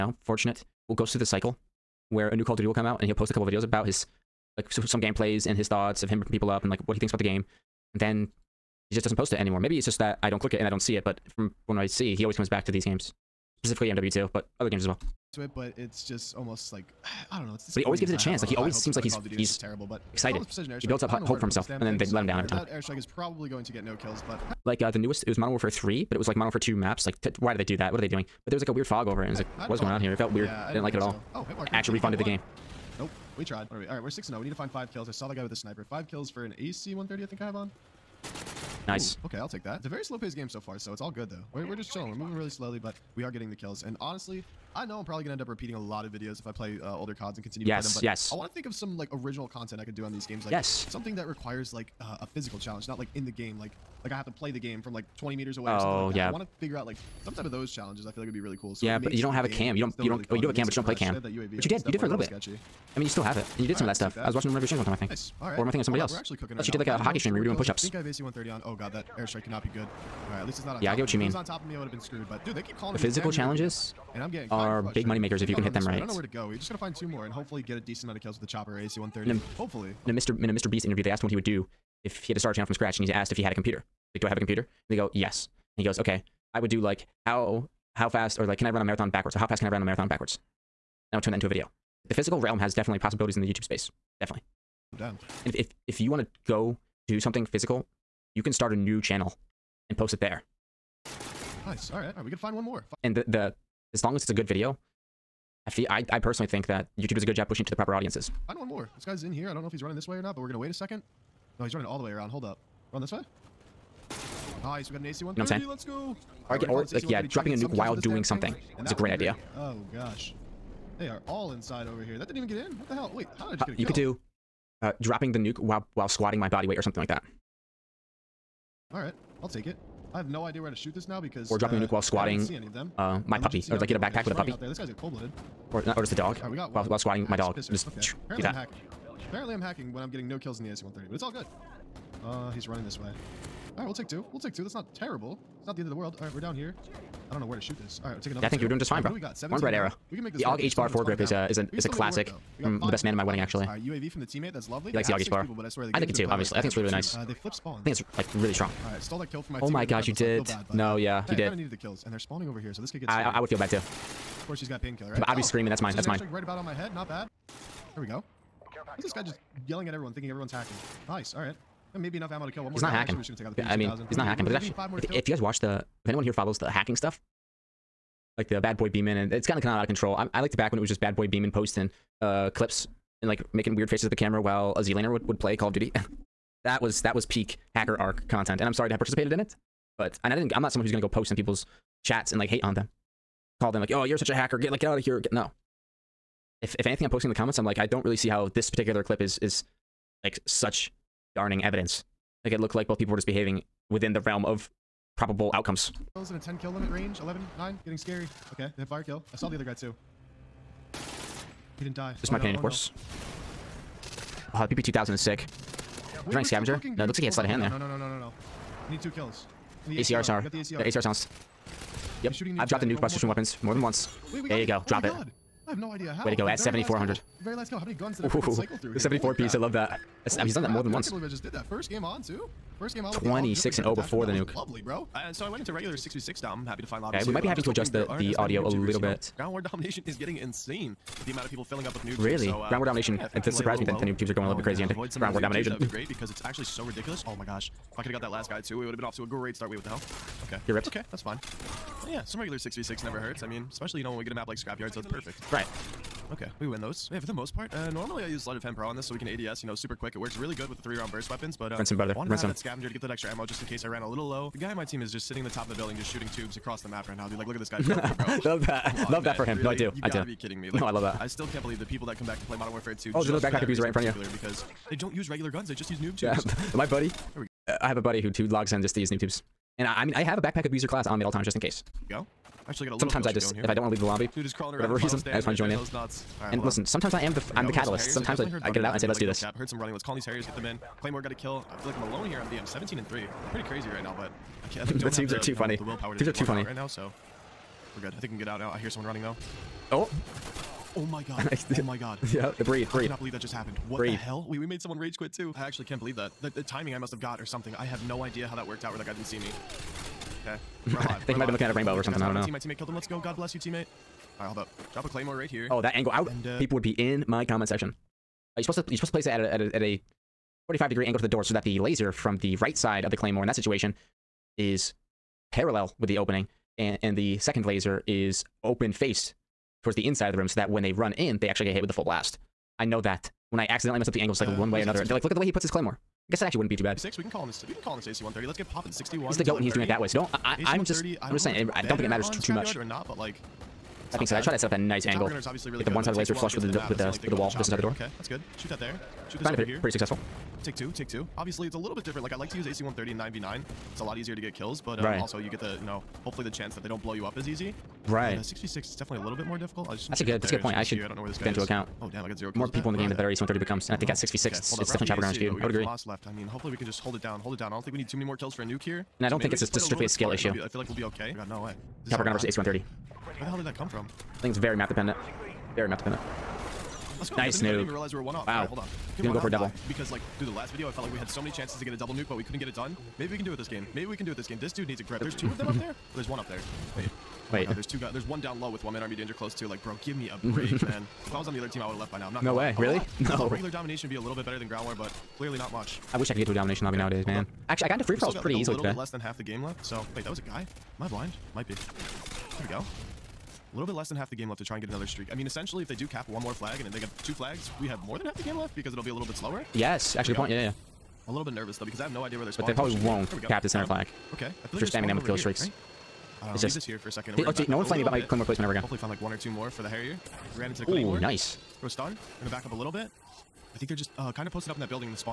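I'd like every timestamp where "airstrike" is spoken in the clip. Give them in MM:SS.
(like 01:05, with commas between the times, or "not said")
00:22, 01:09.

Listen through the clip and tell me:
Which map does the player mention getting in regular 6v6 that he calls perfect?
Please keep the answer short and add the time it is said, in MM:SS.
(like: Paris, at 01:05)
Scrapyard, at 04:14.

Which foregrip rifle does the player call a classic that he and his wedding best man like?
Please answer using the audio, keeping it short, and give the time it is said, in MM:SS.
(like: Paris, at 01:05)
AUG HBAR, at 02:30.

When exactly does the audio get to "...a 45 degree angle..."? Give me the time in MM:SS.
05:19.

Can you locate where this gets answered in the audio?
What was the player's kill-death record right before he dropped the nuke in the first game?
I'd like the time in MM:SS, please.
03:53.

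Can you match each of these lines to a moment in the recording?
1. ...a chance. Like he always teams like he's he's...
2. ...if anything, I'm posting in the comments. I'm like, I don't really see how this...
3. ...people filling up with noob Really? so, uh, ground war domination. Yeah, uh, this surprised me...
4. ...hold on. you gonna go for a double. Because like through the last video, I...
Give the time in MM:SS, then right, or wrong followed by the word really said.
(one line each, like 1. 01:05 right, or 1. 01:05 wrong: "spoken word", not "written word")
1. 00:18 wrong: "seems", not "teams"
2. 03:16 right
3. 04:01 right
4. 06:18 right.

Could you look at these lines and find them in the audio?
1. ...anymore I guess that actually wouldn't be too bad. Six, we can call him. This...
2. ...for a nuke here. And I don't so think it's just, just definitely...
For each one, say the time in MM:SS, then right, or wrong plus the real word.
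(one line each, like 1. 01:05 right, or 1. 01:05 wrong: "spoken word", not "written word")
1. 05:35 wrong: "claymore", not "anymore"
2. 06:08 wrong: "strictly", not "definitely".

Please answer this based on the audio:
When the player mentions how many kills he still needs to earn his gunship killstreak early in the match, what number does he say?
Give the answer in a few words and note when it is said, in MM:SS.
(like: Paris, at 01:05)
5, at 00:35.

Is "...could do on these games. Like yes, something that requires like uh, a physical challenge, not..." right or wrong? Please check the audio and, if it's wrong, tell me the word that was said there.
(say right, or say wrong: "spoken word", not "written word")
right.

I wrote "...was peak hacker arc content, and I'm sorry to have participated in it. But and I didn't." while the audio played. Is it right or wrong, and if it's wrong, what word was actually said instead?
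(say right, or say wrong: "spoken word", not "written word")
right.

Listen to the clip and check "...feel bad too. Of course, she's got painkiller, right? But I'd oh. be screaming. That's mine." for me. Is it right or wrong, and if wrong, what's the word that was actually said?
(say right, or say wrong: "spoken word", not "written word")
right.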